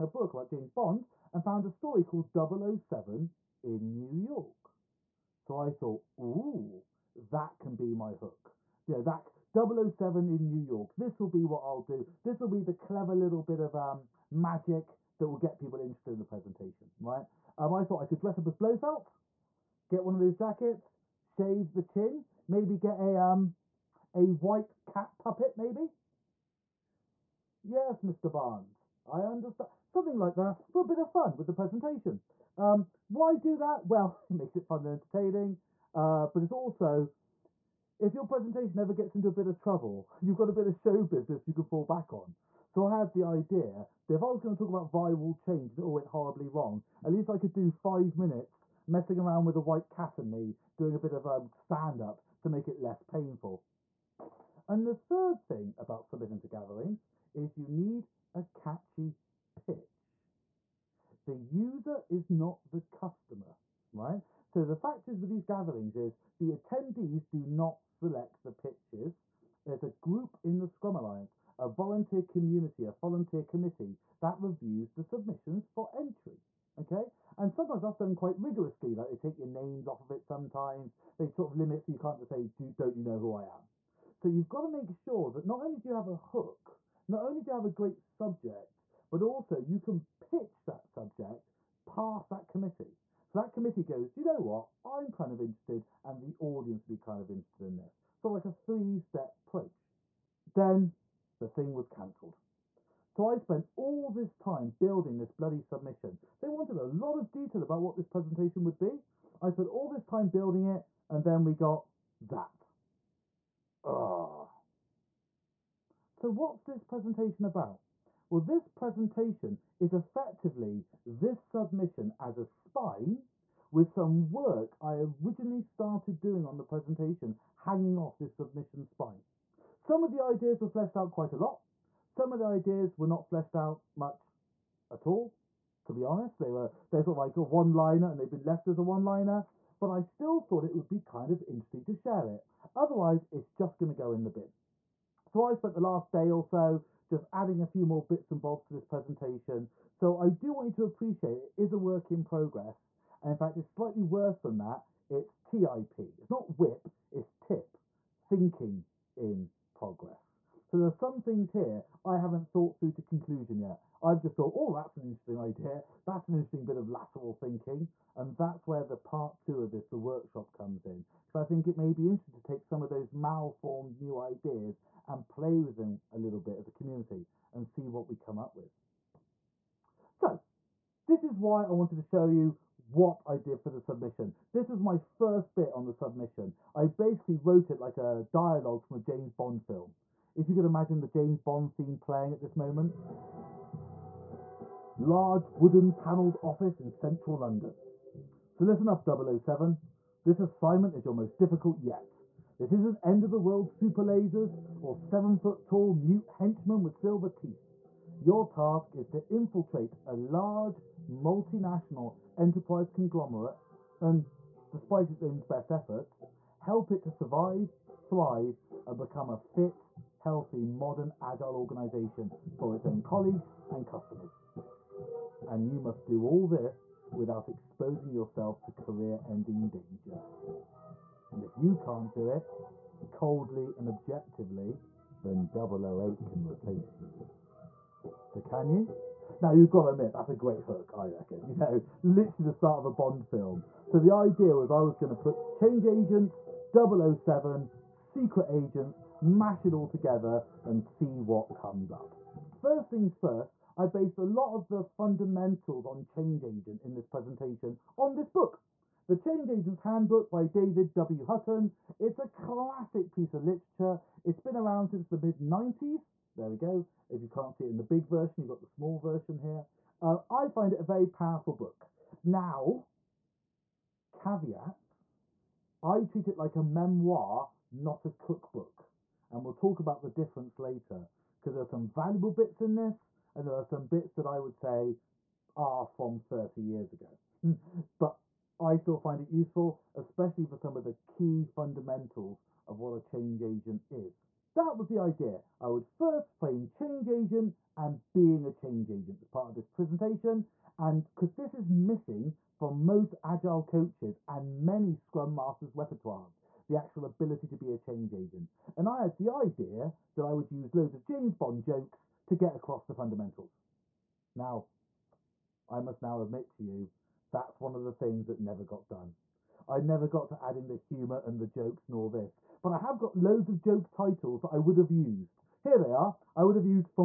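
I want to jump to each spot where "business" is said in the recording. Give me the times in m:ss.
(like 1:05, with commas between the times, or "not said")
0:41.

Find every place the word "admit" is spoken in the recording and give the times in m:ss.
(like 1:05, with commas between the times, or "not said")
3:59, 5:16.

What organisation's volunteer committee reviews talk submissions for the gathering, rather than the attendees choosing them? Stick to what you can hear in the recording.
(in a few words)
Scrum Alliance.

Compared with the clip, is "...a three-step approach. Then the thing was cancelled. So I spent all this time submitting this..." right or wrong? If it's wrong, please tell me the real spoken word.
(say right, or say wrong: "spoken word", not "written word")
wrong: "building", not "submitting".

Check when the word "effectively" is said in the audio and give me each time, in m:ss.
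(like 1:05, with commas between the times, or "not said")
1:59.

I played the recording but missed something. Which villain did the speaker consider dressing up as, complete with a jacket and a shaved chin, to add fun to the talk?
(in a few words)
Blofeld.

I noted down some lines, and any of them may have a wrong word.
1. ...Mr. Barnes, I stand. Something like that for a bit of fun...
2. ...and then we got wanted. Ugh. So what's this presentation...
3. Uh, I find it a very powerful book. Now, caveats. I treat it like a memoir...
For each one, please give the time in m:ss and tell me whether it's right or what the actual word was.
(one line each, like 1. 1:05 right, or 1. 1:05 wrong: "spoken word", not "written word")
1. 0:28 wrong: "understand", not "stand"
2. 1:51 wrong: "zapped", not "wanted"
3. 4:30 right.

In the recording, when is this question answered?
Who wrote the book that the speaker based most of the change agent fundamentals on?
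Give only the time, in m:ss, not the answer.
4:20.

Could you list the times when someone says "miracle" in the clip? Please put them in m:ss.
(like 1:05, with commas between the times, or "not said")
not said.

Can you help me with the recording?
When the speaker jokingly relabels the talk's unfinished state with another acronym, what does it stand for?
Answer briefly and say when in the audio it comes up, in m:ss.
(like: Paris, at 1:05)
Thinking in progress, at 2:38.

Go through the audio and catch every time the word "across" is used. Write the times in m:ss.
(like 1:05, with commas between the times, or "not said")
5:12.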